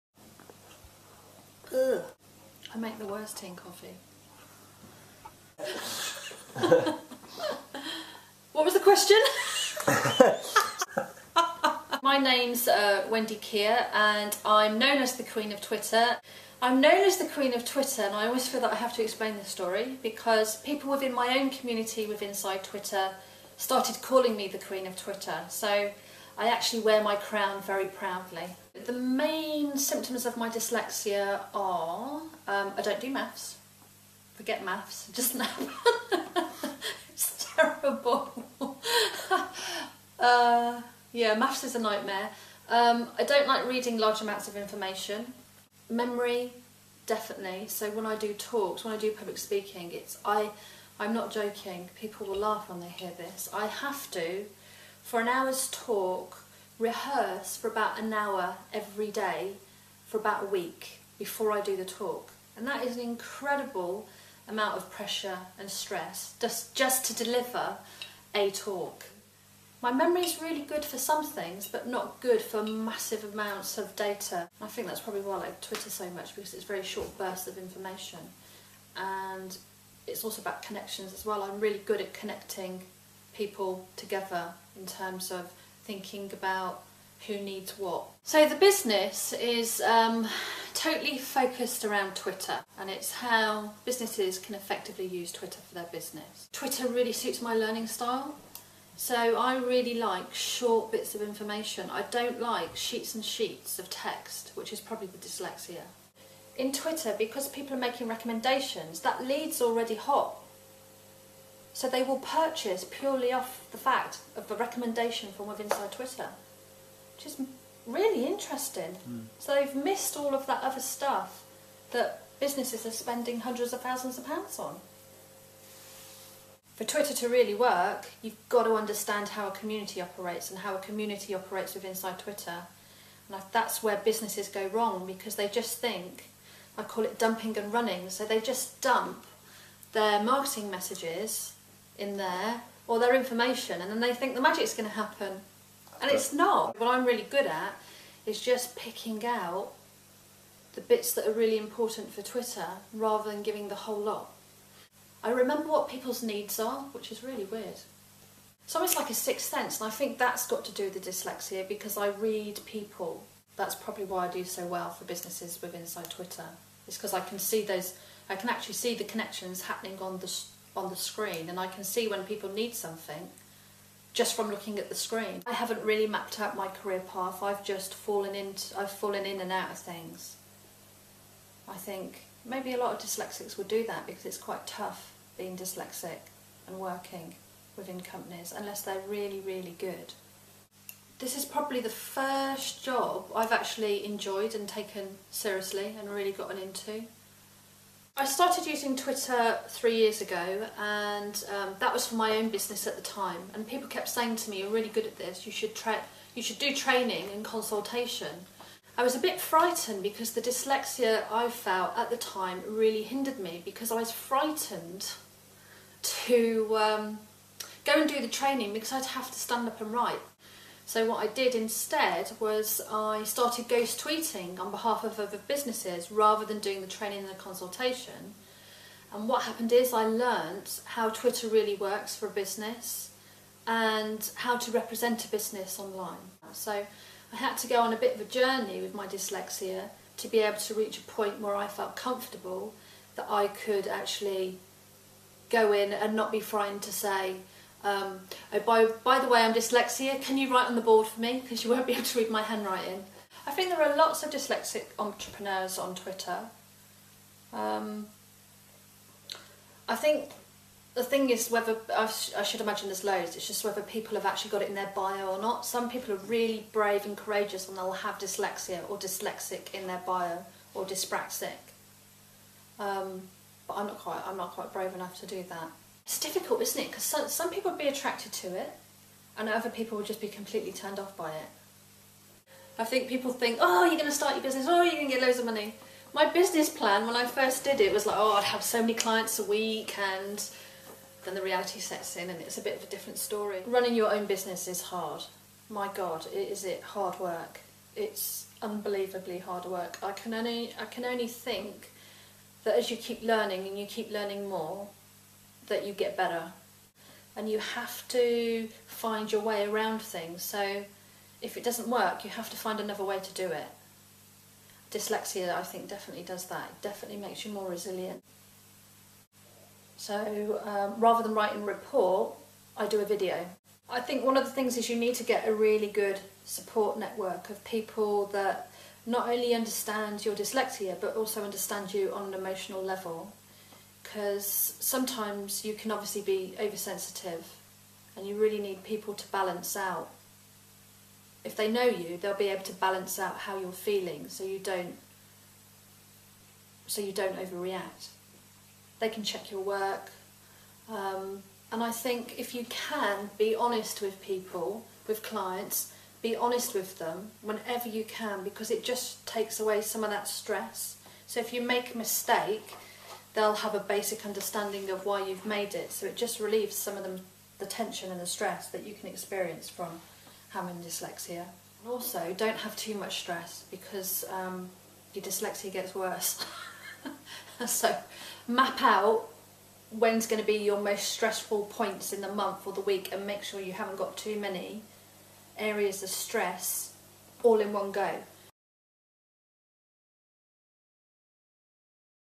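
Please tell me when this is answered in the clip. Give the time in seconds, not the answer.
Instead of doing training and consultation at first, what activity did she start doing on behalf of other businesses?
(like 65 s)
223 s.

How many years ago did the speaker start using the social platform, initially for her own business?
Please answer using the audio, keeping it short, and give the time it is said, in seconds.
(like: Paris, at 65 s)
3, at 199 s.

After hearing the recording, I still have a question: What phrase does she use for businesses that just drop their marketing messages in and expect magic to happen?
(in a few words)
dumping and running.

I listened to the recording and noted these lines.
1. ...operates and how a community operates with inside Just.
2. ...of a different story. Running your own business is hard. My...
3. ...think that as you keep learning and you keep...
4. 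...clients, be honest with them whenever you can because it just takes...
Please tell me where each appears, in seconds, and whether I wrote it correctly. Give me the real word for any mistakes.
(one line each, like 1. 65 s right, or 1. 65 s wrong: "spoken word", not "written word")
1. 130 s wrong: "Twitter", not "Just"
2. 292 s right
3. 301 s right
4. 355 s right.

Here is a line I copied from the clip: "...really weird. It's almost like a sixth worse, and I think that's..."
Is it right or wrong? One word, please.
wrong.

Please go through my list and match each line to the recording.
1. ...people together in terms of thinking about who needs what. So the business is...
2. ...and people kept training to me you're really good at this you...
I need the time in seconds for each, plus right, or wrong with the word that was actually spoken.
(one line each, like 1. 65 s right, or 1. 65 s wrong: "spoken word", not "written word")
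1. 83 s right
2. 203 s wrong: "saying", not "training".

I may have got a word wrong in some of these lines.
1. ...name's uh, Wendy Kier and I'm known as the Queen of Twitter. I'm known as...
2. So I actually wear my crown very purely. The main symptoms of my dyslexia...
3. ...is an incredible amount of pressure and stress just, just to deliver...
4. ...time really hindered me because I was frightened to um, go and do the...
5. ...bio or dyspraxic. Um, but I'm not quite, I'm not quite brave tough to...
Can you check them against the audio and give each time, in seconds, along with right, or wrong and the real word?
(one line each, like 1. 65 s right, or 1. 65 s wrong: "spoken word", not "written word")
1. 12 s right
2. 25 s wrong: "proudly", not "purely"
3. 62 s right
4. 212 s right
5. 270 s wrong: "enough", not "tough".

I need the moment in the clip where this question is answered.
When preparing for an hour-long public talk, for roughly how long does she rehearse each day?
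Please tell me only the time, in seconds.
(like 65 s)
57 s.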